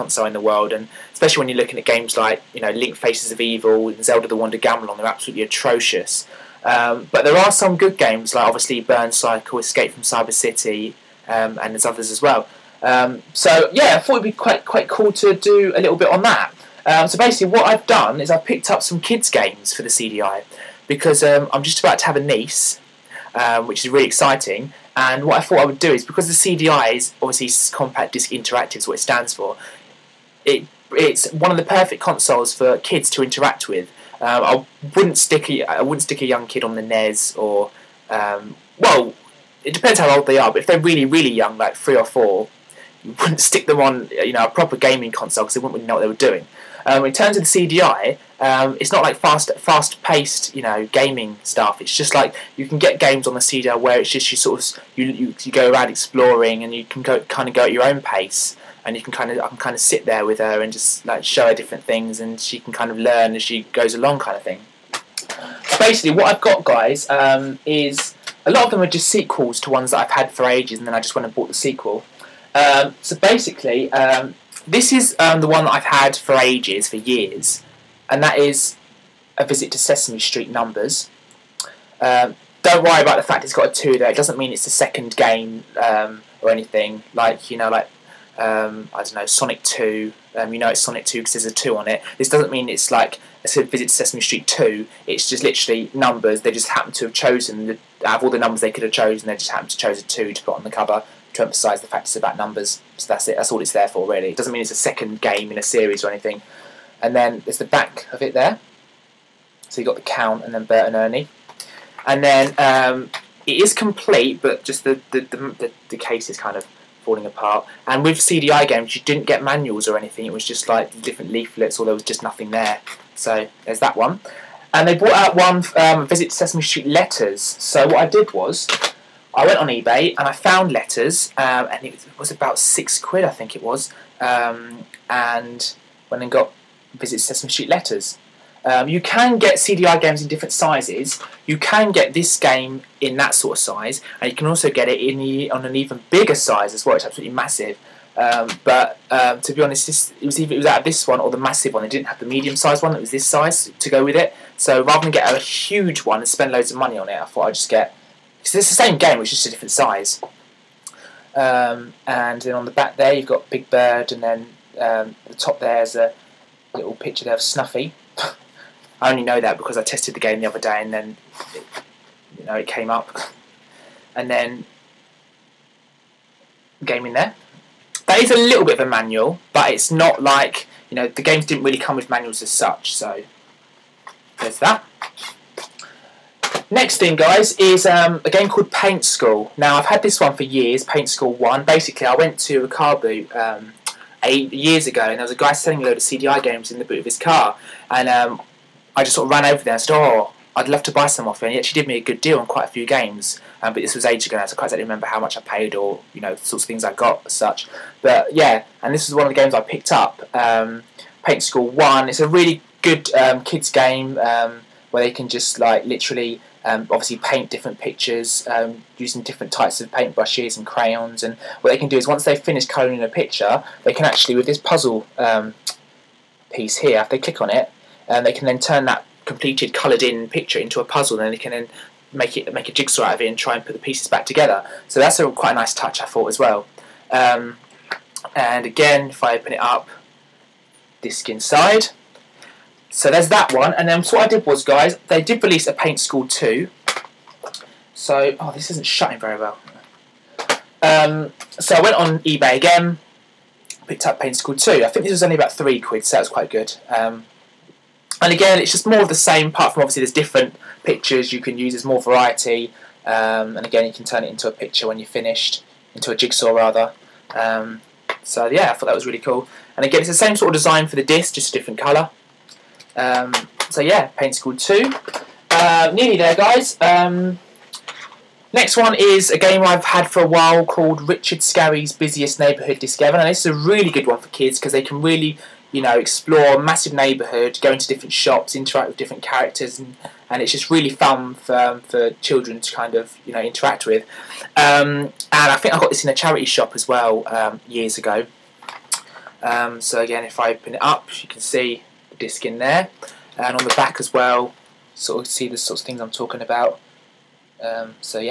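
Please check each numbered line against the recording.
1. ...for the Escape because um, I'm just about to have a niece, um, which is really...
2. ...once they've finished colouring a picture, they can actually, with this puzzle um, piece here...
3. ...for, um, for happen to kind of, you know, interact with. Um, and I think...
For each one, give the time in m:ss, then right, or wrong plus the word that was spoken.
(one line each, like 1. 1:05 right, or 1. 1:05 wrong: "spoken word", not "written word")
1. 0:19 wrong: "CDI", not "Escape"
2. 3:42 right
3. 4:51 wrong: "children", not "happen".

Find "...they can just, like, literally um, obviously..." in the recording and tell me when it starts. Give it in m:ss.
3:35.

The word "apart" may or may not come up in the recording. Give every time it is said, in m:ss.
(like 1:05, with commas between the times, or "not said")
1:57, 4:19.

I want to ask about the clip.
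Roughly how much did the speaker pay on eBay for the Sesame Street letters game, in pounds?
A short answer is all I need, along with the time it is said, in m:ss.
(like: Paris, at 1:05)
6, at 2:12.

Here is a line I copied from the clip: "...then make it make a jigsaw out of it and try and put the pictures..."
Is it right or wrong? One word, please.
wrong.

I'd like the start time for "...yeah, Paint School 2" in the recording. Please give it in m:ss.
4:33.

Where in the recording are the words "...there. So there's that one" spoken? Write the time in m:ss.
2:02.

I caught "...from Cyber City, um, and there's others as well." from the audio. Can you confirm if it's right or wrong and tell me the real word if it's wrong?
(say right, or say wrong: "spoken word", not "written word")
right.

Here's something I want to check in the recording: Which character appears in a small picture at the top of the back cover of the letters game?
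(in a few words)
Snuffy.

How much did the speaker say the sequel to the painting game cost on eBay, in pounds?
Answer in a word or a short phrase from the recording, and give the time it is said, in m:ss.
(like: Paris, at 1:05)
3, at 4:15.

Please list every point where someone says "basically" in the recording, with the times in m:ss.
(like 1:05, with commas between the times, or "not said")
0:17, 1:05, 1:13, 3:11.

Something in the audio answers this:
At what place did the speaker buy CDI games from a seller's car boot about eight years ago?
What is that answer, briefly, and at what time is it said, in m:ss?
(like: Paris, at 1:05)
Rikabu, at 3:12.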